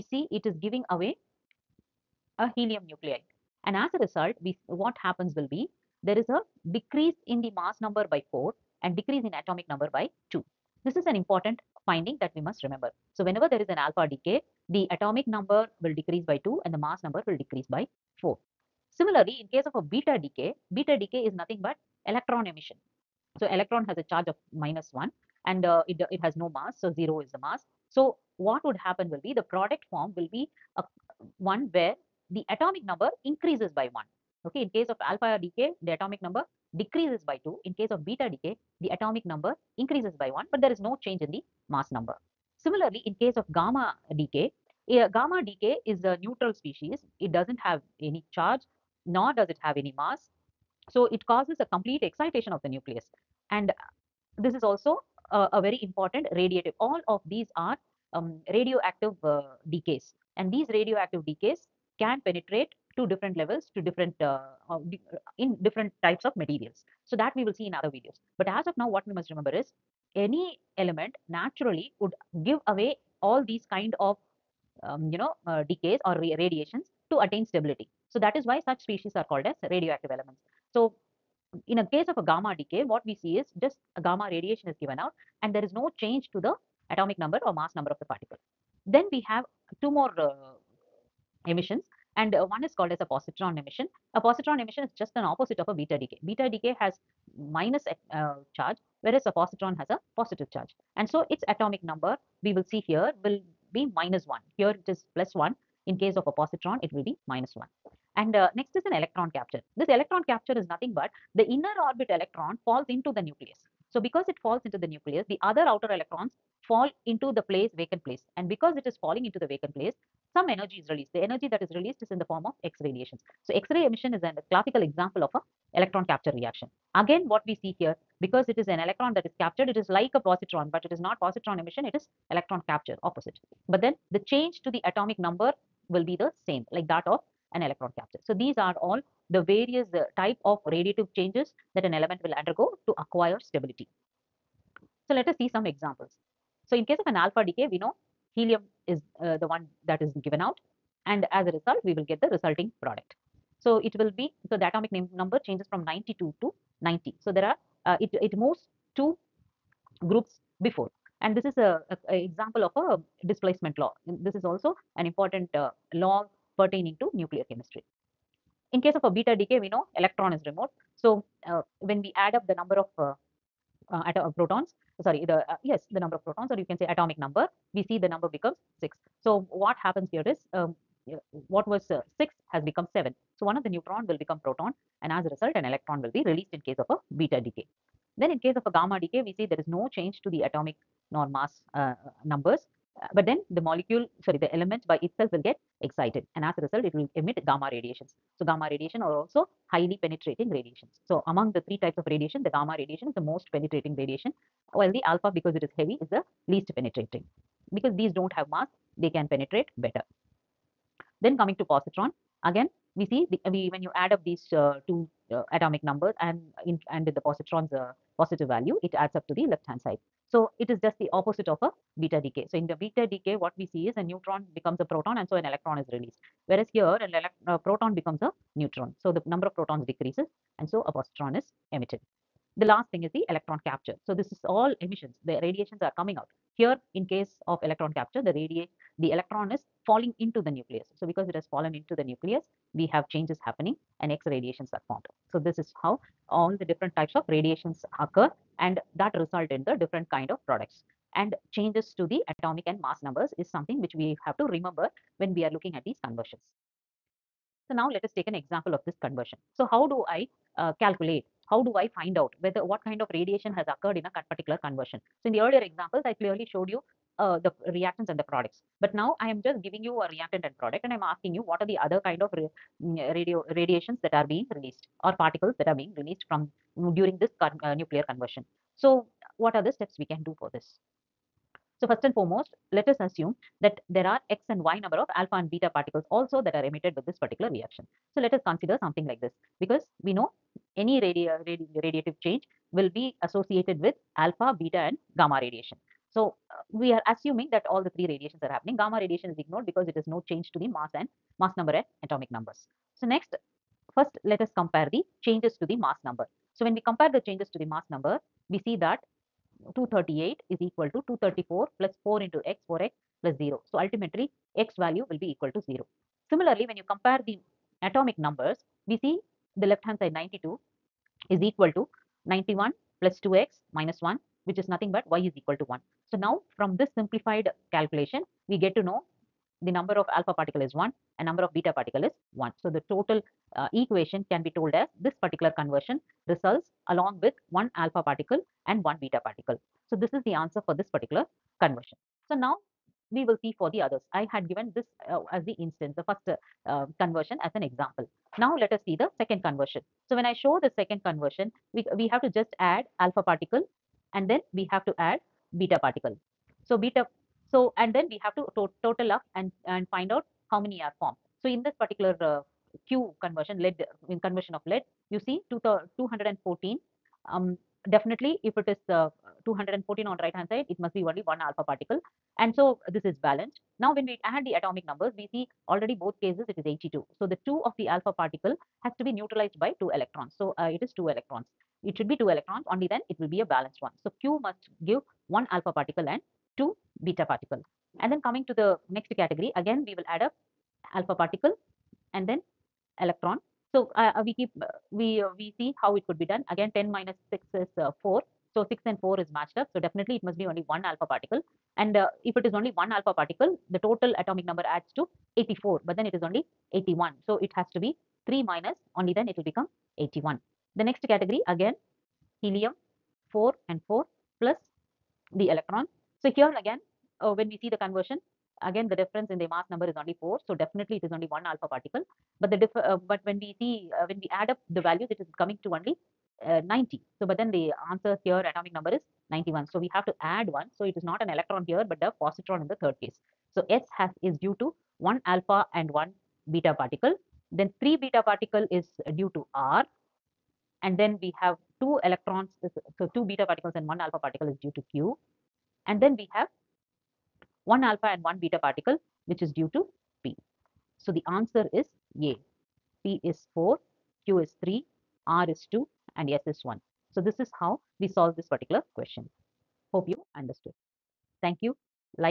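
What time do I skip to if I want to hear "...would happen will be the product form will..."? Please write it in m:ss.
0:28.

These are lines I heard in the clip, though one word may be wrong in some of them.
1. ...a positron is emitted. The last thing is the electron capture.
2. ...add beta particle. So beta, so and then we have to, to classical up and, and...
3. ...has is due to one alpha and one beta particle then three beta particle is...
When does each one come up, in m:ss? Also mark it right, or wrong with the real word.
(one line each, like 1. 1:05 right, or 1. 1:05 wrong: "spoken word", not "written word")
1. 3:50 right
2. 5:54 wrong: "total", not "classical"
3. 7:13 right.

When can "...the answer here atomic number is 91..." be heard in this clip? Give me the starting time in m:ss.
7:07.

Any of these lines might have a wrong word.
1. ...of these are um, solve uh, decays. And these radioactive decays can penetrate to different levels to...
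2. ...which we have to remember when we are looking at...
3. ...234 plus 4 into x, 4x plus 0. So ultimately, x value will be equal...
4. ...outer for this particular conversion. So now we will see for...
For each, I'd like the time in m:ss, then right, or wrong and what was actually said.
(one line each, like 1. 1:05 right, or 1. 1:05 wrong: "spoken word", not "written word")
1. 0:57 wrong: "radioactive", not "solve"
2. 4:13 right
3. 5:11 right
4. 5:40 wrong: "answer", not "outer".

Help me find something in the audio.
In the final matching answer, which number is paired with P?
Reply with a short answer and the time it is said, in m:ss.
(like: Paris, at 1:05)
4, at 7:33.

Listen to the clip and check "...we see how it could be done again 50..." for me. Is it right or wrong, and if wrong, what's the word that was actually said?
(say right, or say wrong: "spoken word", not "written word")
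wrong: "10", not "50".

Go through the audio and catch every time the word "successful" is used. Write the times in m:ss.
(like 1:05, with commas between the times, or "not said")
not said.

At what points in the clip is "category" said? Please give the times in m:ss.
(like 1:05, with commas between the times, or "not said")
6:29, 6:51.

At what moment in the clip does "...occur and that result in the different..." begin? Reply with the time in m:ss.
4:07.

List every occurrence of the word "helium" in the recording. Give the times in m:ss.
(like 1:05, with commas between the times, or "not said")
0:02, 2:28, 6:52.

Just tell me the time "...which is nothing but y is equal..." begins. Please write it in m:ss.
5:24.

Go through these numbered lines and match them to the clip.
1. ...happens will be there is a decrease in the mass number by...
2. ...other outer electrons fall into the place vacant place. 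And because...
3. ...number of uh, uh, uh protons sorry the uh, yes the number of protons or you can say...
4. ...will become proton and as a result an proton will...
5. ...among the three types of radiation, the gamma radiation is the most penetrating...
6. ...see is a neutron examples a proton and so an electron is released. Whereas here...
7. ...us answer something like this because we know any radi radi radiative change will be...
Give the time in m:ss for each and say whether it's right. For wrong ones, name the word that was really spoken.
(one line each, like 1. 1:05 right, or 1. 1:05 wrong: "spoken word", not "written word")
1. 0:05 right
2. 1:55 right
3. 2:52 right
4. 3:04 wrong: "electron", not "proton"
5. 3:21 right
6. 3:43 wrong: "becomes", not "examples"
7. 4:48 wrong: "consider", not "answer".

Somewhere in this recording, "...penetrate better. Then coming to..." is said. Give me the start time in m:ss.
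3:29.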